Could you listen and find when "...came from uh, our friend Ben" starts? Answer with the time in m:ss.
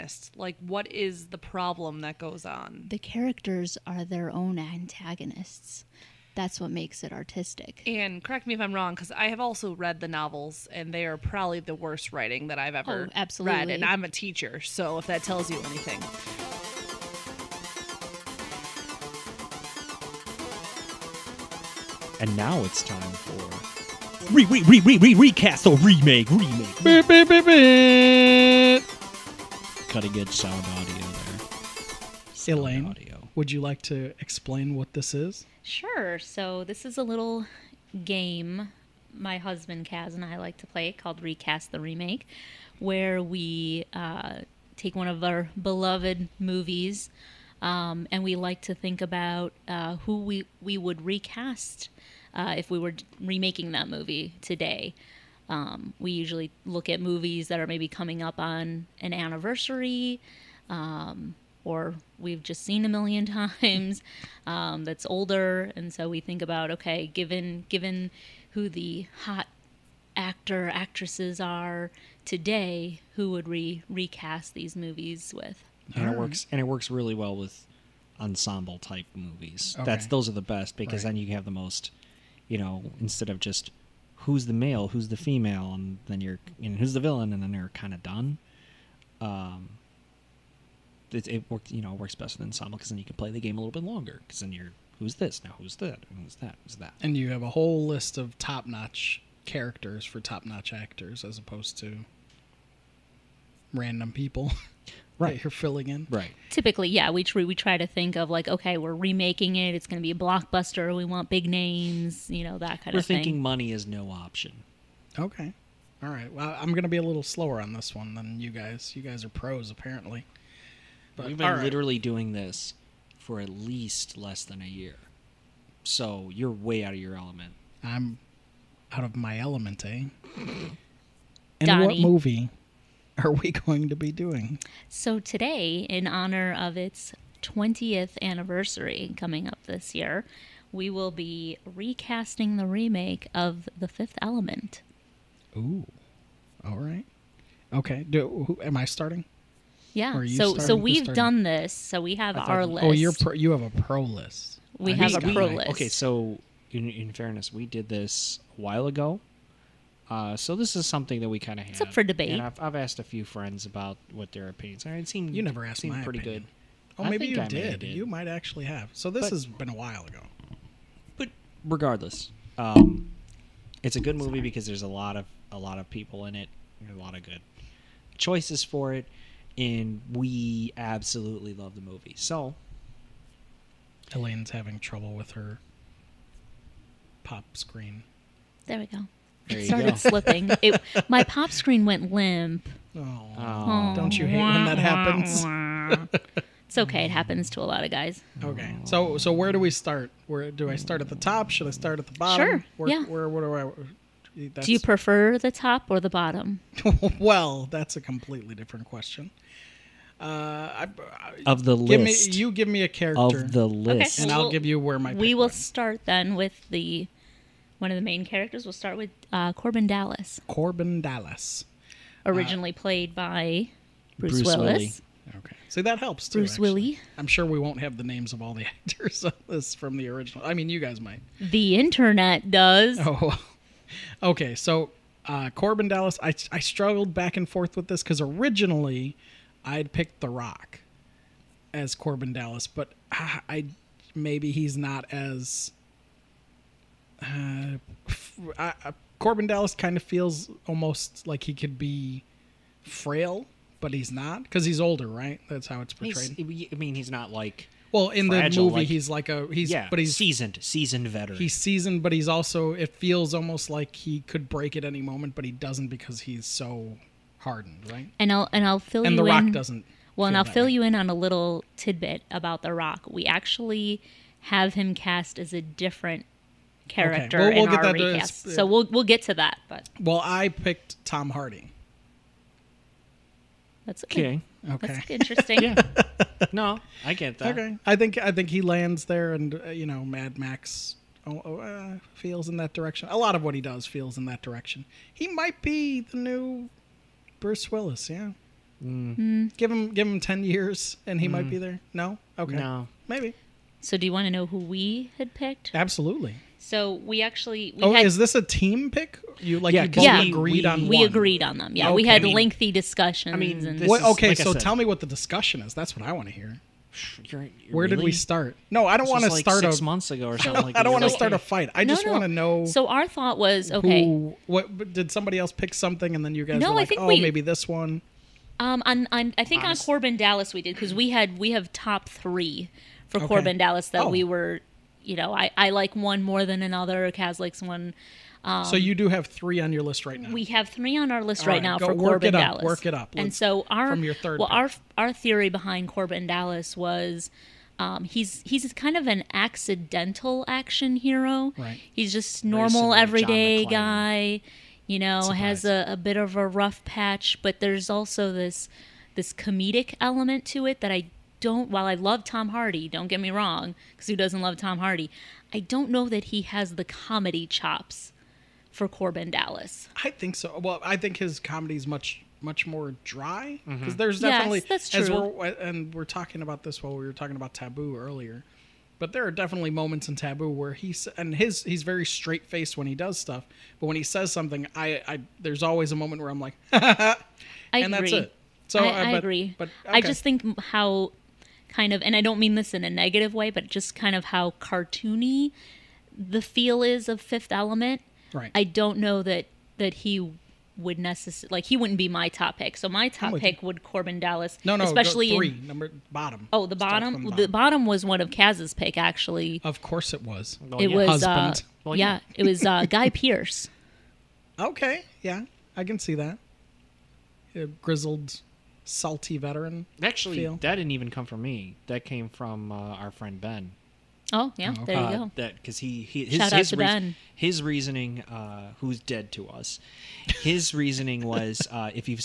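7:02.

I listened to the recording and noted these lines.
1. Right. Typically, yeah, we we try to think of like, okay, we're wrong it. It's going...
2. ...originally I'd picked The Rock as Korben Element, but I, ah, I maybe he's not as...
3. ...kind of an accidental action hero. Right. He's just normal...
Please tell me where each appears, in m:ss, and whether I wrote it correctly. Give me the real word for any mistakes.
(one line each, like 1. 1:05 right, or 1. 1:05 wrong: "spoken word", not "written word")
1. 1:46 wrong: "remaking", not "wrong"
2. 3:58 wrong: "Dallas", not "Element"
3. 5:48 right.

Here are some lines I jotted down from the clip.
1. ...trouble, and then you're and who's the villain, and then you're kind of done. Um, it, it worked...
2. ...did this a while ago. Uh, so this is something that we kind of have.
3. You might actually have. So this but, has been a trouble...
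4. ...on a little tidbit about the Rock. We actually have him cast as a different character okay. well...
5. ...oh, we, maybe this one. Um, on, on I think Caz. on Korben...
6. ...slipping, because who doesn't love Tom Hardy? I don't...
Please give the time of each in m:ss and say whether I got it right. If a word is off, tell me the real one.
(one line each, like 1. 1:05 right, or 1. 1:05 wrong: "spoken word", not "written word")
1. 1:25 wrong: "female", not "trouble"
2. 2:37 right
3. 2:47 wrong: "while", not "trouble"
4. 4:30 right
5. 5:27 wrong: "Honest", not "Caz"
6. 6:03 wrong: "wrong", not "slipping".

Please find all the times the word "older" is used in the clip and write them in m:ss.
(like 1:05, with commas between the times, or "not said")
1:05, 4:14.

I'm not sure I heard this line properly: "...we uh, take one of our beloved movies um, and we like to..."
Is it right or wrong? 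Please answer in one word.
right.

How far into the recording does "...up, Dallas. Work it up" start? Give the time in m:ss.
5:42.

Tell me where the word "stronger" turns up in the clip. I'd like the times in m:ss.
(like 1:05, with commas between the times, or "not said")
not said.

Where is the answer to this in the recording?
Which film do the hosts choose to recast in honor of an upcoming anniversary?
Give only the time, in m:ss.
2:23.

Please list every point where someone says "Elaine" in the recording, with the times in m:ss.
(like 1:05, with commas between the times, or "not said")
0:32, 3:04.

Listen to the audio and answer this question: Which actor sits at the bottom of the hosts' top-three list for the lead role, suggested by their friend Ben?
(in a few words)
Guy Pearce.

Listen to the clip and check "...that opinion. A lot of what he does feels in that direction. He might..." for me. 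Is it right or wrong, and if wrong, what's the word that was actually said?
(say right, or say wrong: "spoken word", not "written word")
wrong: "direction", not "opinion".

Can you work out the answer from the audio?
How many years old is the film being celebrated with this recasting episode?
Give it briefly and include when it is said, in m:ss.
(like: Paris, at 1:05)
20, at 2:17.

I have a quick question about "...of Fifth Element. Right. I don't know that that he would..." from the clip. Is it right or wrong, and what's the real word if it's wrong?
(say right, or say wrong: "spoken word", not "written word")
right.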